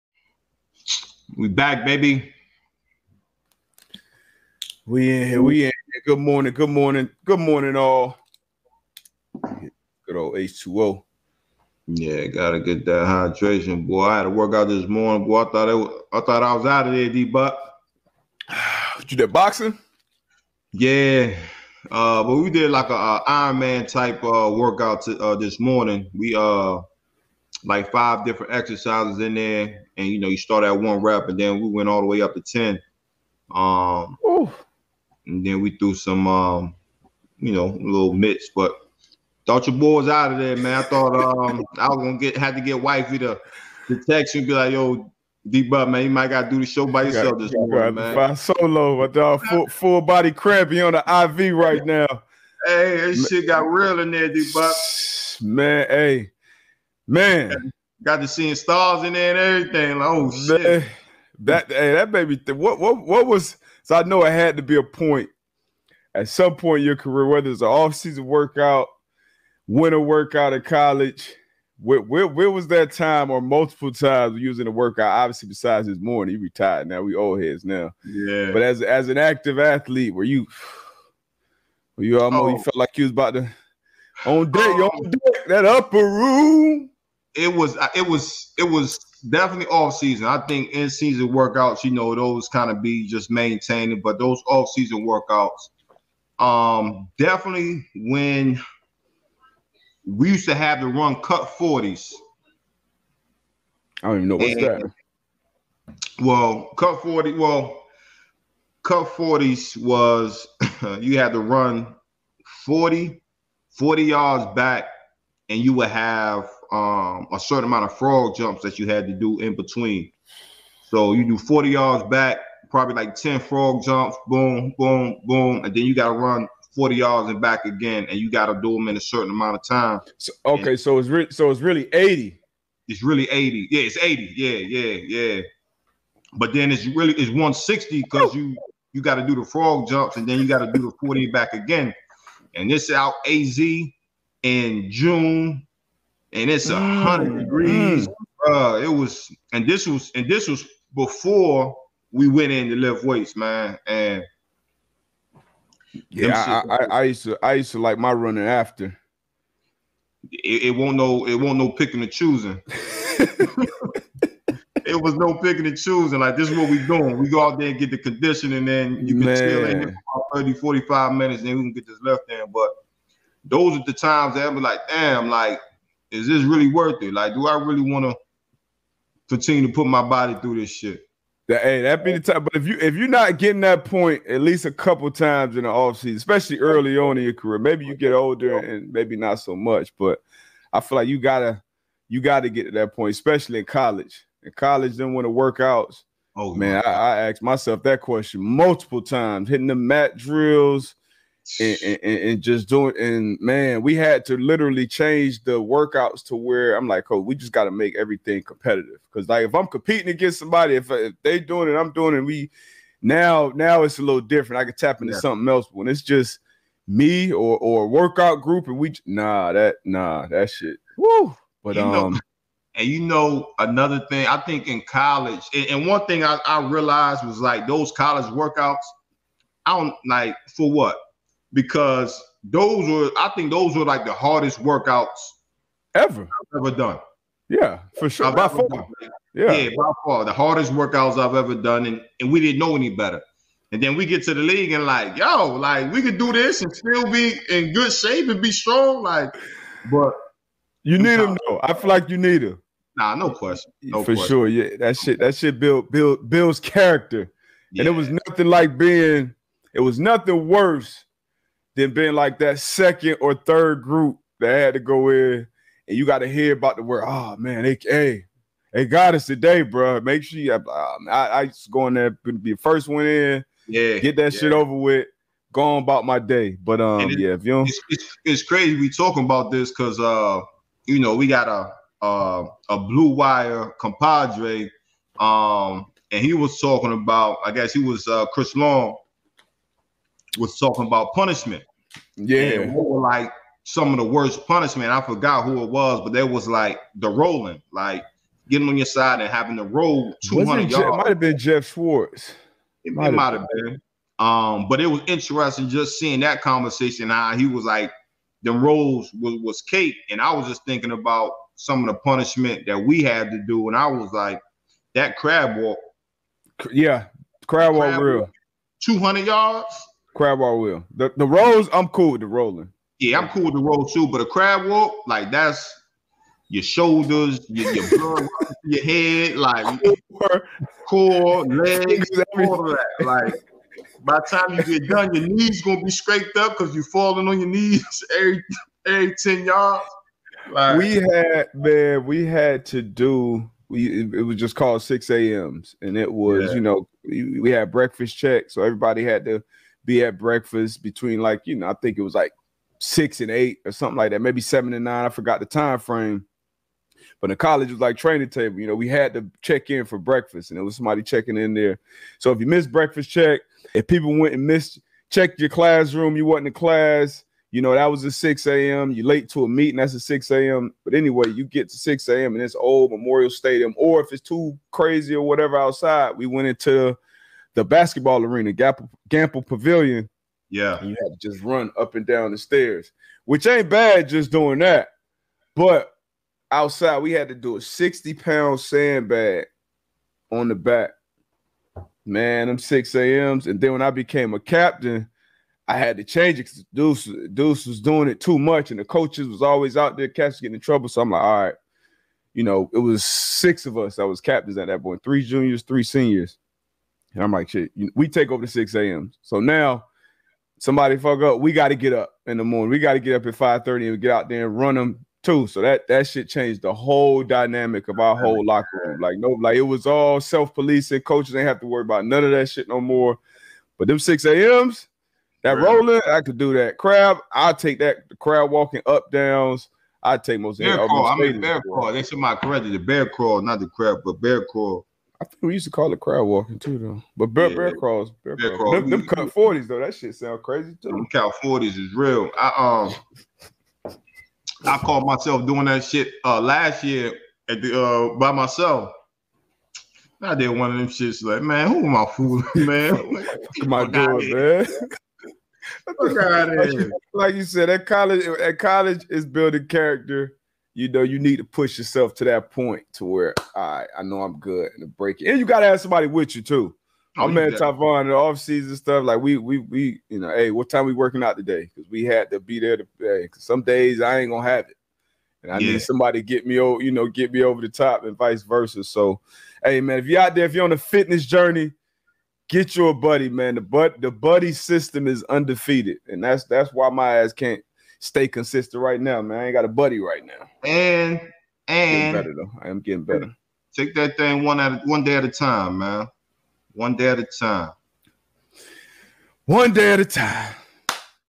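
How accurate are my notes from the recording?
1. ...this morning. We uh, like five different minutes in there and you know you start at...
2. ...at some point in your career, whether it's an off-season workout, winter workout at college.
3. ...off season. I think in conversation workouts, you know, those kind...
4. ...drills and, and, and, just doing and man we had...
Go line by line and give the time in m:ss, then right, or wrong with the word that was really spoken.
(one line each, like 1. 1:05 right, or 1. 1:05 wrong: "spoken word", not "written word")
1. 0:25 wrong: "exercises", not "minutes"
2. 1:06 right
3. 1:29 wrong: "season", not "conversation"
4. 3:20 right.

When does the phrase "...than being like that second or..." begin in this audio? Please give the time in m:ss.
4:21.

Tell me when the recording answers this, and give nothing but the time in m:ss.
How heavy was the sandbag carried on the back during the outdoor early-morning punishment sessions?
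6:27.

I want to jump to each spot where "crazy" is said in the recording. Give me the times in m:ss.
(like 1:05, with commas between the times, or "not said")
4:38, 6:14, 7:20.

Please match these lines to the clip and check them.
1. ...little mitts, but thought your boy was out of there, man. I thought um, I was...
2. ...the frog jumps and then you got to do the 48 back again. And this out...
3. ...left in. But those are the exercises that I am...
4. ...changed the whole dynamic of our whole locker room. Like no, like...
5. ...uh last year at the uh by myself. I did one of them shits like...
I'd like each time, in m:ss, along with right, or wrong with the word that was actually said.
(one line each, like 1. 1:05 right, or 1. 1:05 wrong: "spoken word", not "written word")
1. 0:37 right
2. 2:19 wrong: "40", not "48"
3. 2:52 wrong: "times", not "exercises"
4. 6:56 right
5. 7:26 right.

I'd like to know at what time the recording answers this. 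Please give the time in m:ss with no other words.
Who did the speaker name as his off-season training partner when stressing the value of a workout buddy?
7:47.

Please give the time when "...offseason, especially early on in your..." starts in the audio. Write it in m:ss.
3:05.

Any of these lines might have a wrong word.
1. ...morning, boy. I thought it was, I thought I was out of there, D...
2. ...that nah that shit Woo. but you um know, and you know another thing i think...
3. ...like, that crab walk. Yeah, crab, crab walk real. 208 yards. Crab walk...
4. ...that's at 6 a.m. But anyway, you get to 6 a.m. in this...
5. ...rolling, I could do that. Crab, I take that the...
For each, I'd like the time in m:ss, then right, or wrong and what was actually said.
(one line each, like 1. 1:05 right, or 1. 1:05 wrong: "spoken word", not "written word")
1. 0:14 right
2. 3:39 right
3. 5:14 wrong: "200", not "208"
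4. 6:09 right
5. 7:05 right.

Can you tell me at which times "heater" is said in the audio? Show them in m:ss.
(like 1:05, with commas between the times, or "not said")
not said.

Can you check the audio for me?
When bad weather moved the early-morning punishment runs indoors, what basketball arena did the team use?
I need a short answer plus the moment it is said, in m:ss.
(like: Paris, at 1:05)
Gampel Pavilion, at 6:18.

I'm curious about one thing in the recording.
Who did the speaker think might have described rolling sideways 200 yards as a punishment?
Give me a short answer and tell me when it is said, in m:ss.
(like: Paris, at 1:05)
Geoff Schwartz, at 5:01.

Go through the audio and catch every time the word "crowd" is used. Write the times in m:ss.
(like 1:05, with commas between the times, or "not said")
7:08, 7:15.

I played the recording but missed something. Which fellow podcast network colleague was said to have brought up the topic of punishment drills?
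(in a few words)
Chris Long.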